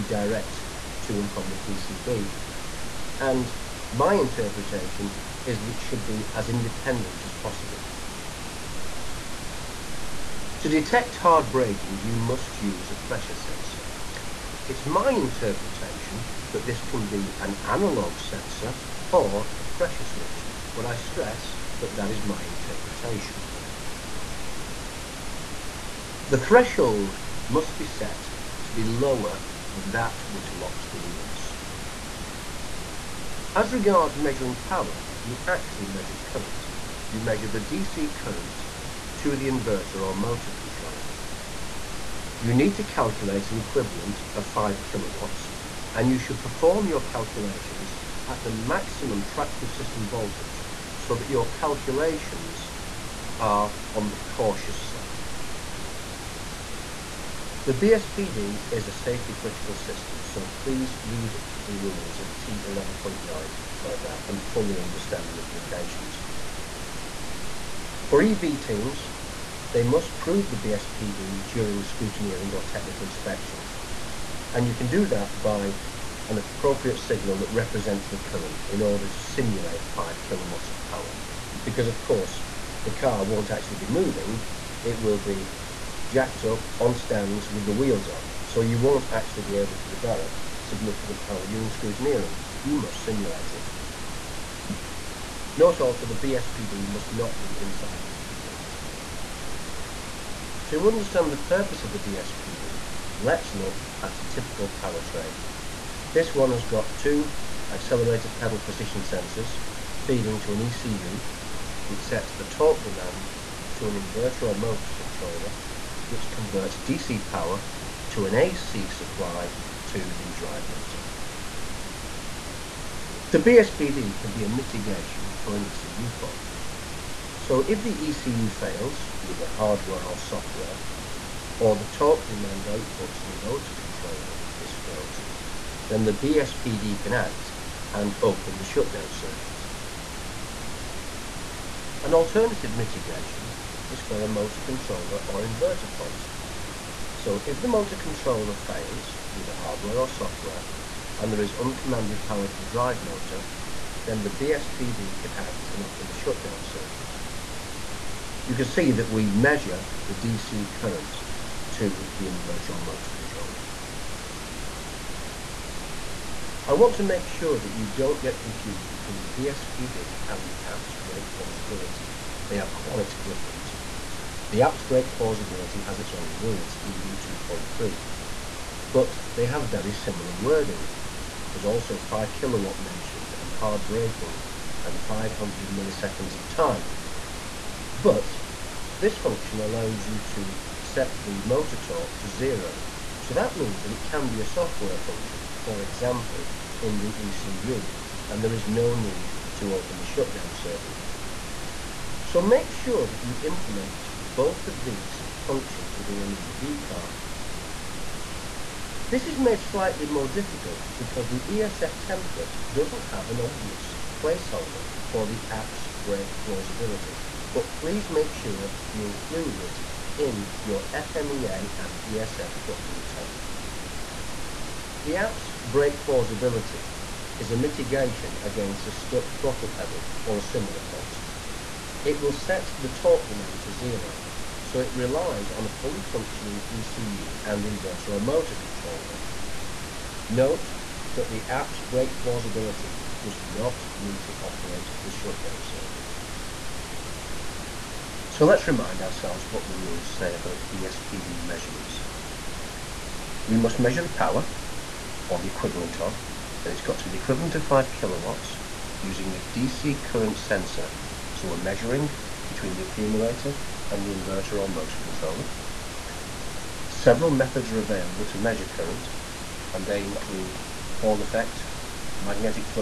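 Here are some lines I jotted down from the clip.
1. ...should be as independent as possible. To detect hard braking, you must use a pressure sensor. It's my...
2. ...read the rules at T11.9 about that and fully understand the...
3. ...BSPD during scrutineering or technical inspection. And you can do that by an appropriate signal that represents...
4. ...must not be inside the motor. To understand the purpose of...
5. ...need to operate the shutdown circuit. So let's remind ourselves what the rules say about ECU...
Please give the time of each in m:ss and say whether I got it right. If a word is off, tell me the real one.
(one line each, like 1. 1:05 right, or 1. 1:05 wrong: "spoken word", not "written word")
1. 0:05 right
2. 1:01 right
3. 1:10 right
4. 1:36 wrong: "accumulator", not "motor"
5. 4:03 wrong: "BSPD", not "ECU".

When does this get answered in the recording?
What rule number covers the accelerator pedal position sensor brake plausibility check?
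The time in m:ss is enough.
2:56.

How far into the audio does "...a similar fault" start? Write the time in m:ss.
3:50.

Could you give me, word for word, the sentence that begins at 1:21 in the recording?
Because of course, the car won't actually be moving, it will be jacked up on stands with the wheels off.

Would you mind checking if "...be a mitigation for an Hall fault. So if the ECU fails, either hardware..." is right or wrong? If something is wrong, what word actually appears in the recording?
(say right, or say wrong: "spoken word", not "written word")
wrong: "ECU", not "Hall".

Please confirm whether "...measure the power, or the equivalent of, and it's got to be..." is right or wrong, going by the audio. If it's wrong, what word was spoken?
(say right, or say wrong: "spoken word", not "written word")
right.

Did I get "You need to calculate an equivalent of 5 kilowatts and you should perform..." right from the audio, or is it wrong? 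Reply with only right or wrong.
right.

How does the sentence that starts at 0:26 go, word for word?
The threshold must be set to be lower than that which locks the wheels.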